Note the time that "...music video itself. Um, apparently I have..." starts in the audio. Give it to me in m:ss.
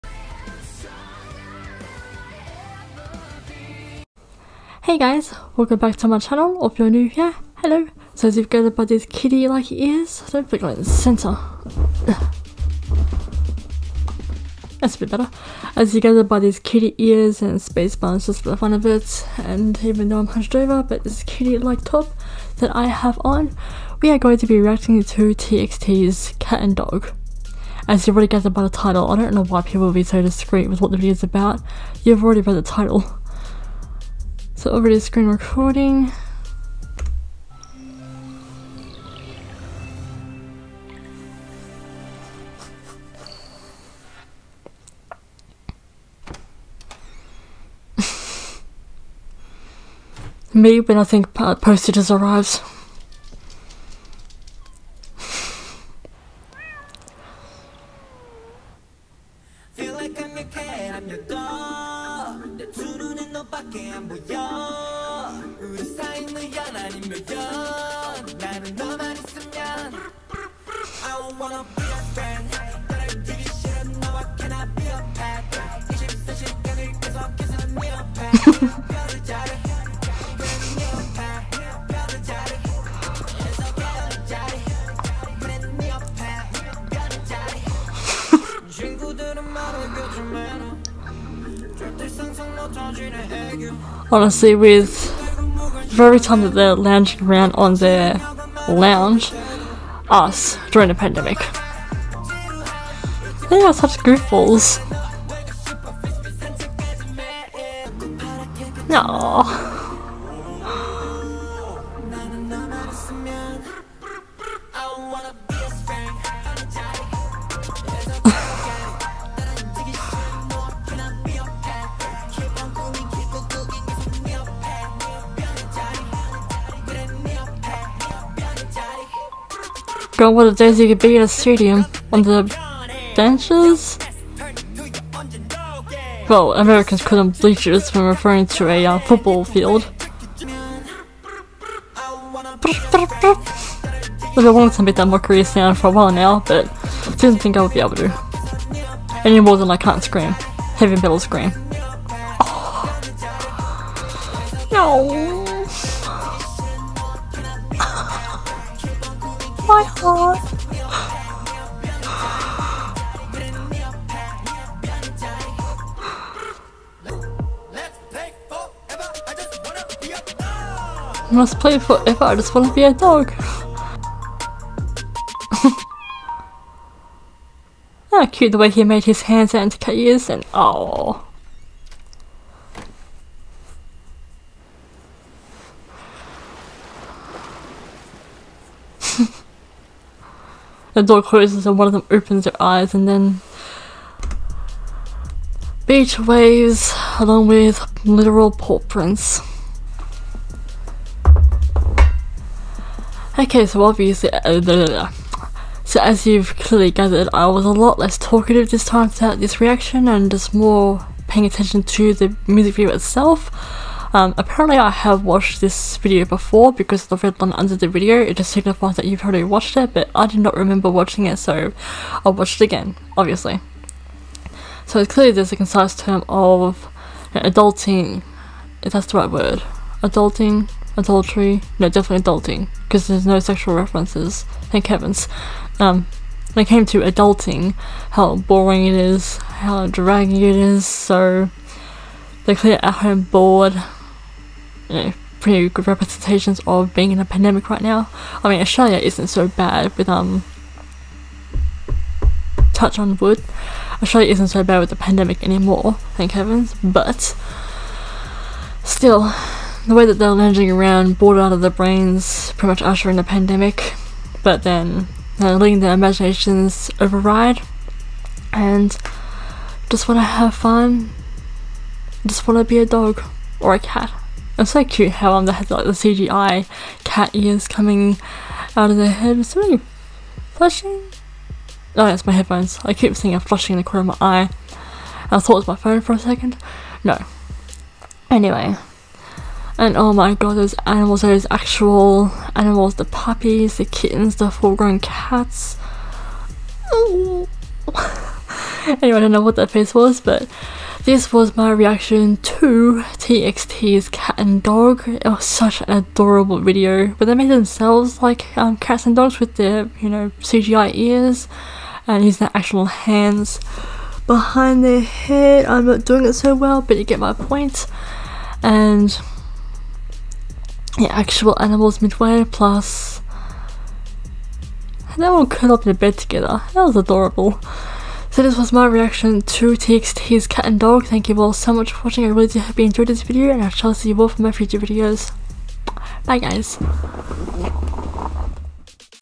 3:32.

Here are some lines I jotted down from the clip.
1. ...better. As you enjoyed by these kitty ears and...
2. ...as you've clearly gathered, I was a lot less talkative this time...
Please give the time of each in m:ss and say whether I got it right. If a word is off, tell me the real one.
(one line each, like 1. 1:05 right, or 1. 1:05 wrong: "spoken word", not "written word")
1. 0:15 wrong: "gathered", not "enjoyed"
2. 3:26 right.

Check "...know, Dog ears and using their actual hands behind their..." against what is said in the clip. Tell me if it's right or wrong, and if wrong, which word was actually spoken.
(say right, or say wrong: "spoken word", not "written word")
wrong: "CGI", not "Dog".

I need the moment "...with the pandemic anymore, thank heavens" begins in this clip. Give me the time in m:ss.
4:14.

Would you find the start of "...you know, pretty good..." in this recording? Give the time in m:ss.
4:04.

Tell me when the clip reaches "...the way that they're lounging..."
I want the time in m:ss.
4:19.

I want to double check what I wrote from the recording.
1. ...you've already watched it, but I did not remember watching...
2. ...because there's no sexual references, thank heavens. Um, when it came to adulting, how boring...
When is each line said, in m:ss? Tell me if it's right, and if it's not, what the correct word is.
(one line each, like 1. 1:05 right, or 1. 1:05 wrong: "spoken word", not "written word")
1. 3:39 right
2. 3:52 right.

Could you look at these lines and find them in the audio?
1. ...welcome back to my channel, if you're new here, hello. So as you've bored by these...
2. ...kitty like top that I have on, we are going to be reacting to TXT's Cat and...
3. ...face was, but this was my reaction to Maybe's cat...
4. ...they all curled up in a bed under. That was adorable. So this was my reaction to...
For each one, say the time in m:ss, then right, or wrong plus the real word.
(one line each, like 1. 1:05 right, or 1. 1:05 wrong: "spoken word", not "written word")
1. 0:05 wrong: "gathered", not "bored"
2. 0:21 right
3. 4:59 wrong: "TXT", not "Maybe"
4. 5:25 wrong: "together", not "under".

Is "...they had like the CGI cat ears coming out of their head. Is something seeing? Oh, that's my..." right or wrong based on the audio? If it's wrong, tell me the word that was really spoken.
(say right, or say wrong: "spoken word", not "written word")
wrong: "flashing", not "seeing".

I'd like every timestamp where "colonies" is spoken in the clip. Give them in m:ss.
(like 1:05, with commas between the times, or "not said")
not said.